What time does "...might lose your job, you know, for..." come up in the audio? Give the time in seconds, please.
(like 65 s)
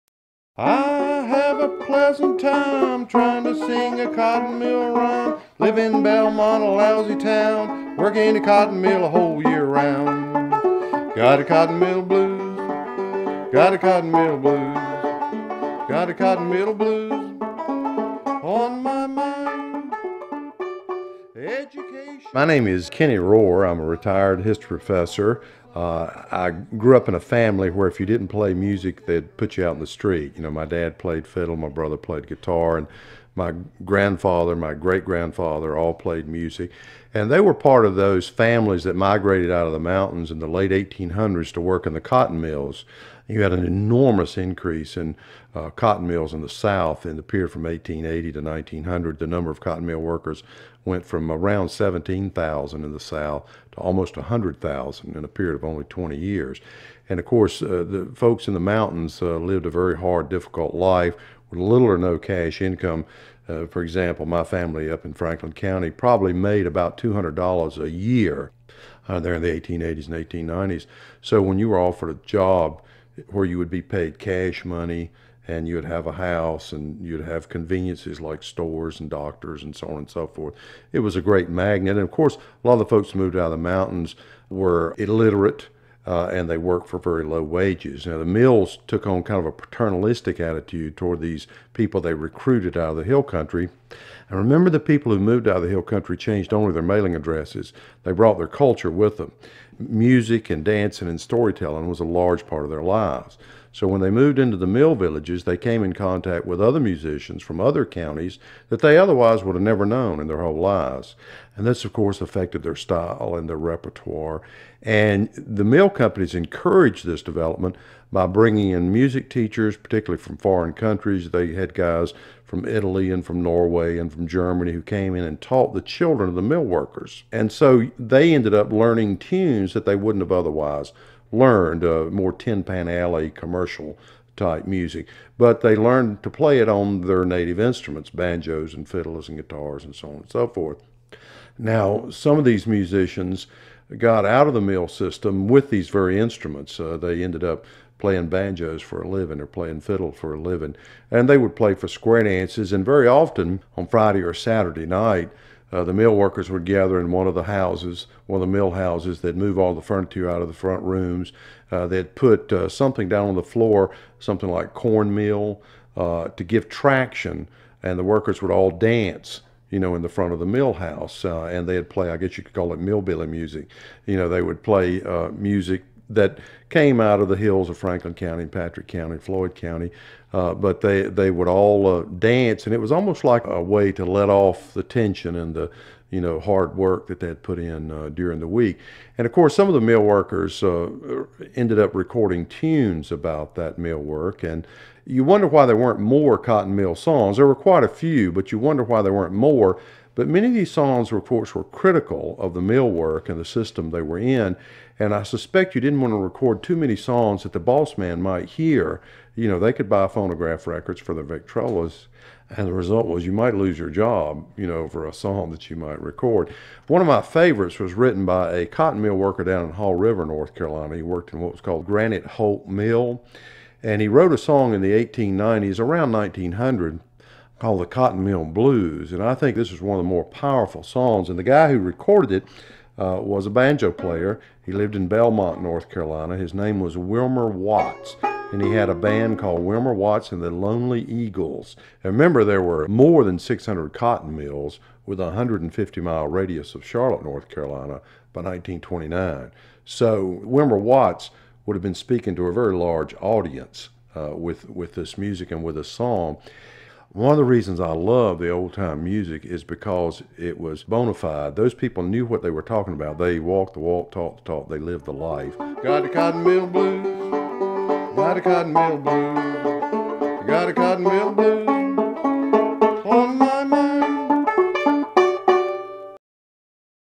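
213 s.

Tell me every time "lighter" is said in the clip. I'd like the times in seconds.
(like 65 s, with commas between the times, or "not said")
not said.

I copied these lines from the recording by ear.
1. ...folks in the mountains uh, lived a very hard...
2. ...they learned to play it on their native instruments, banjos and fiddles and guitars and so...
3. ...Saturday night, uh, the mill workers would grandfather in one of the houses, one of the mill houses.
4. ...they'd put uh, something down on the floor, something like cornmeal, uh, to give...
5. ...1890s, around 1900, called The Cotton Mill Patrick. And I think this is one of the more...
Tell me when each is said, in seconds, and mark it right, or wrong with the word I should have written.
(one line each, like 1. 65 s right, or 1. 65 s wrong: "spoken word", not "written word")
1. 58 s right
2. 135 s right
3. 154 s wrong: "gather", not "grandfather"
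4. 161 s right
5. 224 s wrong: "Blues", not "Patrick".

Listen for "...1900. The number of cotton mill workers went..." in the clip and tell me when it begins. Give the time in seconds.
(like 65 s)
48 s.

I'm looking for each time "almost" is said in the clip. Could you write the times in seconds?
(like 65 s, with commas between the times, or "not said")
53 s, 182 s.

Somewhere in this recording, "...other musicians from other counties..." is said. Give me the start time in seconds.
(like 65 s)
106 s.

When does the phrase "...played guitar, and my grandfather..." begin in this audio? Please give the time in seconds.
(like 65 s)
31 s.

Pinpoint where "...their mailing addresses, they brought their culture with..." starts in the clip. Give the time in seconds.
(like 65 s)
96 s.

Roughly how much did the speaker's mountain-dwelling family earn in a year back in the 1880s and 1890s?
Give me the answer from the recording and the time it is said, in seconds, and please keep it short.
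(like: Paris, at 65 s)
$200, at 66 s.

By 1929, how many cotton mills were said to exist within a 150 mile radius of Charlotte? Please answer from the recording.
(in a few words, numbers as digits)
More than 600.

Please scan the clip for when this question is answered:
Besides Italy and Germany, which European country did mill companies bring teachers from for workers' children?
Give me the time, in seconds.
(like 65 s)
123 s.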